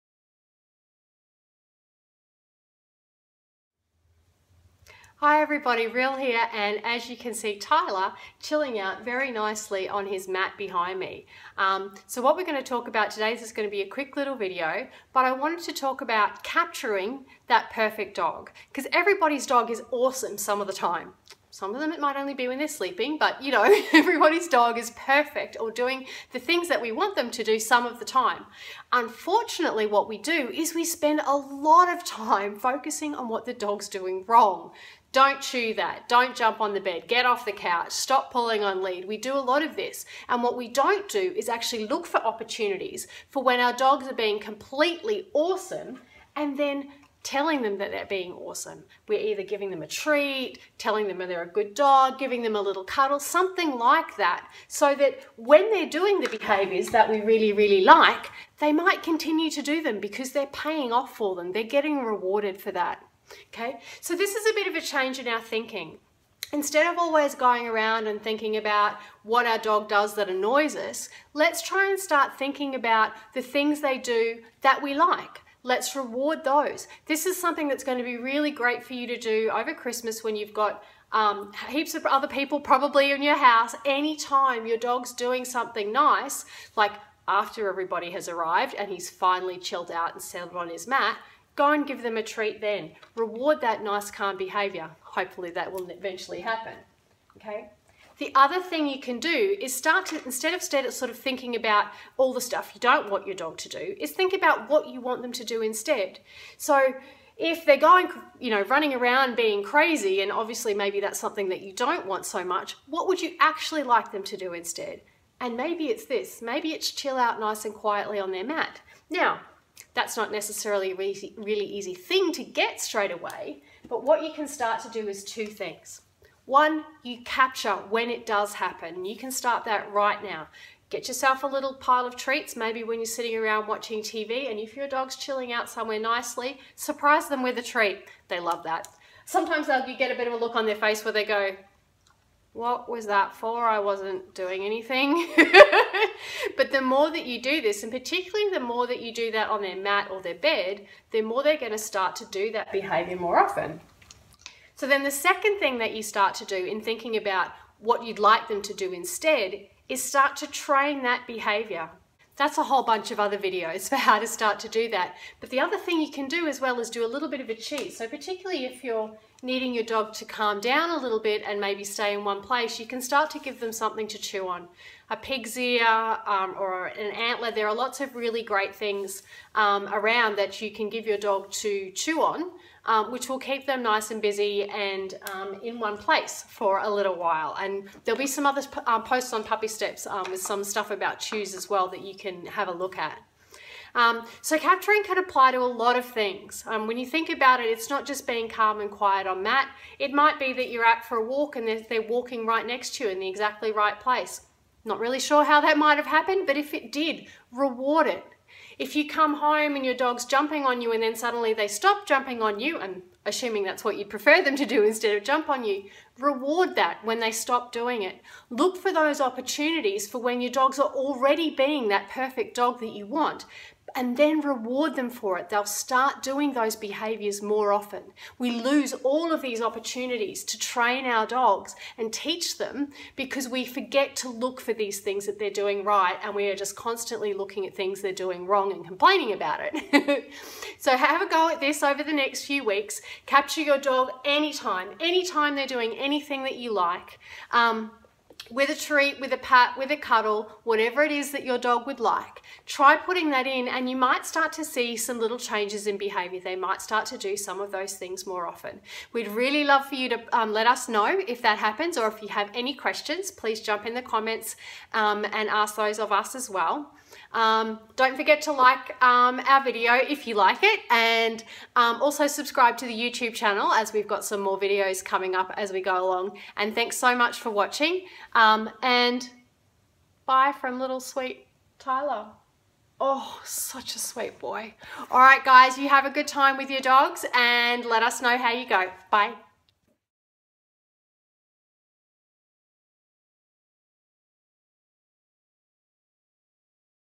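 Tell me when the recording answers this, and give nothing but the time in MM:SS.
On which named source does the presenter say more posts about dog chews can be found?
03:09.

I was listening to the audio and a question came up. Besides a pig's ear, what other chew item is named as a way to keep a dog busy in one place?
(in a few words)
An antler.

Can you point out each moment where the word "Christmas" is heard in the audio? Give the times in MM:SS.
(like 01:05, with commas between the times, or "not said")
01:19.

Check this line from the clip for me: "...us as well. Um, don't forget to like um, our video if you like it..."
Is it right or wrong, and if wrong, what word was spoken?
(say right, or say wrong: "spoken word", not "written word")
right.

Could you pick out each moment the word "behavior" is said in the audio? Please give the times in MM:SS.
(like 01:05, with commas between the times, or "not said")
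00:56, 01:34, 02:32, 02:41, 03:46, 04:15.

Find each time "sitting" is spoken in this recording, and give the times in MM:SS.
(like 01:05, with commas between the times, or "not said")
02:13.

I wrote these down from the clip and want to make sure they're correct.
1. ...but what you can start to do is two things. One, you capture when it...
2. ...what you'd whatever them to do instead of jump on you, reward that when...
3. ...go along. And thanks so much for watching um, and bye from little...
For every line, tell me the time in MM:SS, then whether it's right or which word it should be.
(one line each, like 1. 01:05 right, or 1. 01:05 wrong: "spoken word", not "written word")
1. 02:03 right
2. 03:33 wrong: "prefer", not "whatever"
3. 04:35 right.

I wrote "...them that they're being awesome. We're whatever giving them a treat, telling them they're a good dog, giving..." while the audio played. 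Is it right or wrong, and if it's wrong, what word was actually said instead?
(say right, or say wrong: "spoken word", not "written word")
wrong: "either", not "whatever".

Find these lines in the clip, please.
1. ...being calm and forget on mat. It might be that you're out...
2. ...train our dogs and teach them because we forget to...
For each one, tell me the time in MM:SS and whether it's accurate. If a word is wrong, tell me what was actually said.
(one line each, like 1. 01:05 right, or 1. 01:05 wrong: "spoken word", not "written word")
1. 03:18 wrong: "quiet", not "forget"
2. 03:50 right.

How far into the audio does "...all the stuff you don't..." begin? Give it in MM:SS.
01:42.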